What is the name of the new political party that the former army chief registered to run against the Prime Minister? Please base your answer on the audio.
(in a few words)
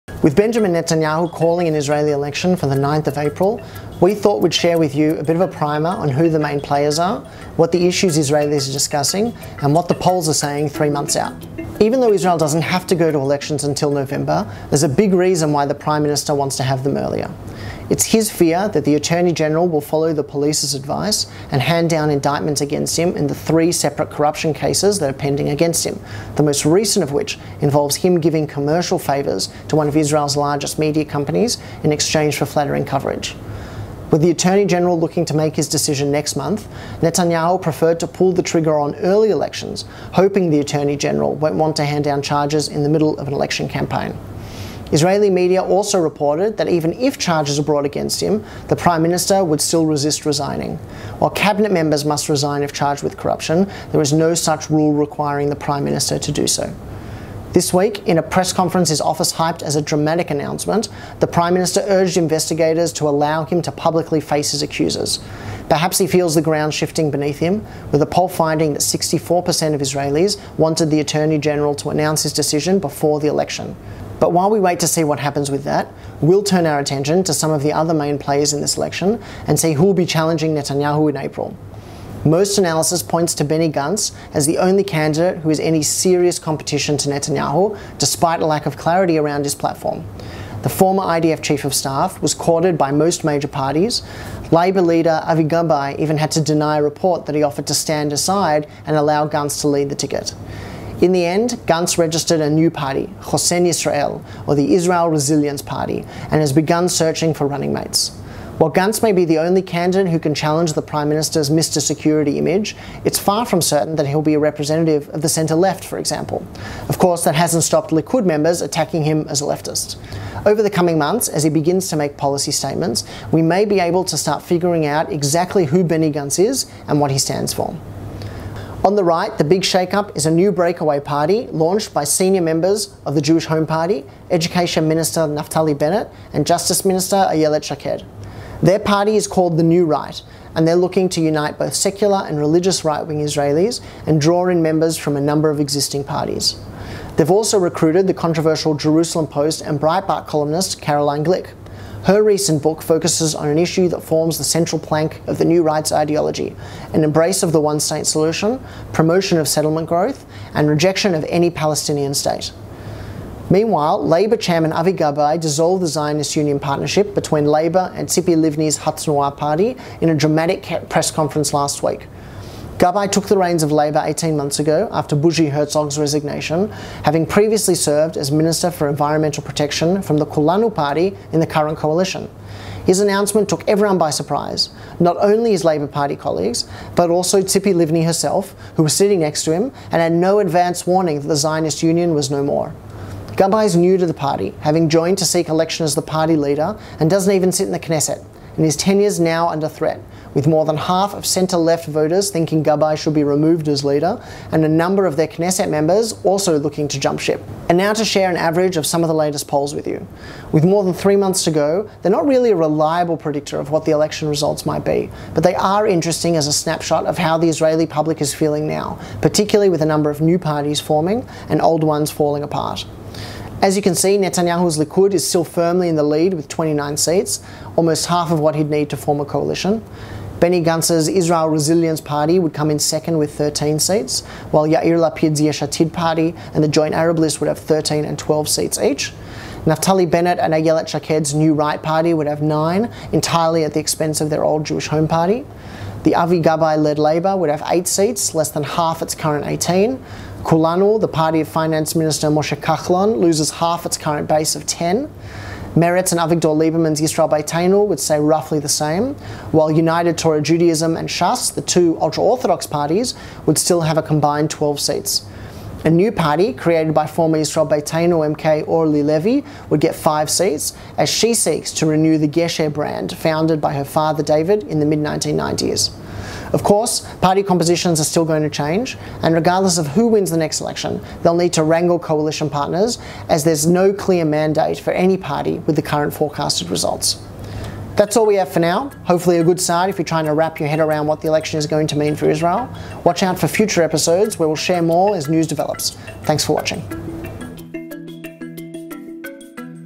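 Hosen Israel.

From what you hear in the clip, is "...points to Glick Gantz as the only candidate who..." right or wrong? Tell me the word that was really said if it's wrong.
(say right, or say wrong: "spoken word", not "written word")
wrong: "Benny", not "Glick".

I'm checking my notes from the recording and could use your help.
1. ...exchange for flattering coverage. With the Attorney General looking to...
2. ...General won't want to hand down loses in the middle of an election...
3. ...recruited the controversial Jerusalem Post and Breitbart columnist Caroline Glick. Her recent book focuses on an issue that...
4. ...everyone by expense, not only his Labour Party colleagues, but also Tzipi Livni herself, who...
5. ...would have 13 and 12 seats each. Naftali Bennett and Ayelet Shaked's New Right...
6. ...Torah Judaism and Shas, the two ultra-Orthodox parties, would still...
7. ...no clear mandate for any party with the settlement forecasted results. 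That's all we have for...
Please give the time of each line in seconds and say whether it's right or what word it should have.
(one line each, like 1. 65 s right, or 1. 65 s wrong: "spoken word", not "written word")
1. 31 s right
2. 40 s wrong: "charges", not "loses"
3. 147 s right
4. 183 s wrong: "surprise", not "expense"
5. 237 s right
6. 260 s right
7. 283 s wrong: "current", not "settlement".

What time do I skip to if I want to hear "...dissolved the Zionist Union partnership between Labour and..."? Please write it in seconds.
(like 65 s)
165 s.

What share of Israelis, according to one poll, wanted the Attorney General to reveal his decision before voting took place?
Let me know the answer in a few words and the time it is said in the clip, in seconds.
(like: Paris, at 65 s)
64%, at 68 s.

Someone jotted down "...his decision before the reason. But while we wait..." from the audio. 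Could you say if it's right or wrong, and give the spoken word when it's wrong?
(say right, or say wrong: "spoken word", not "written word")
wrong: "election", not "reason".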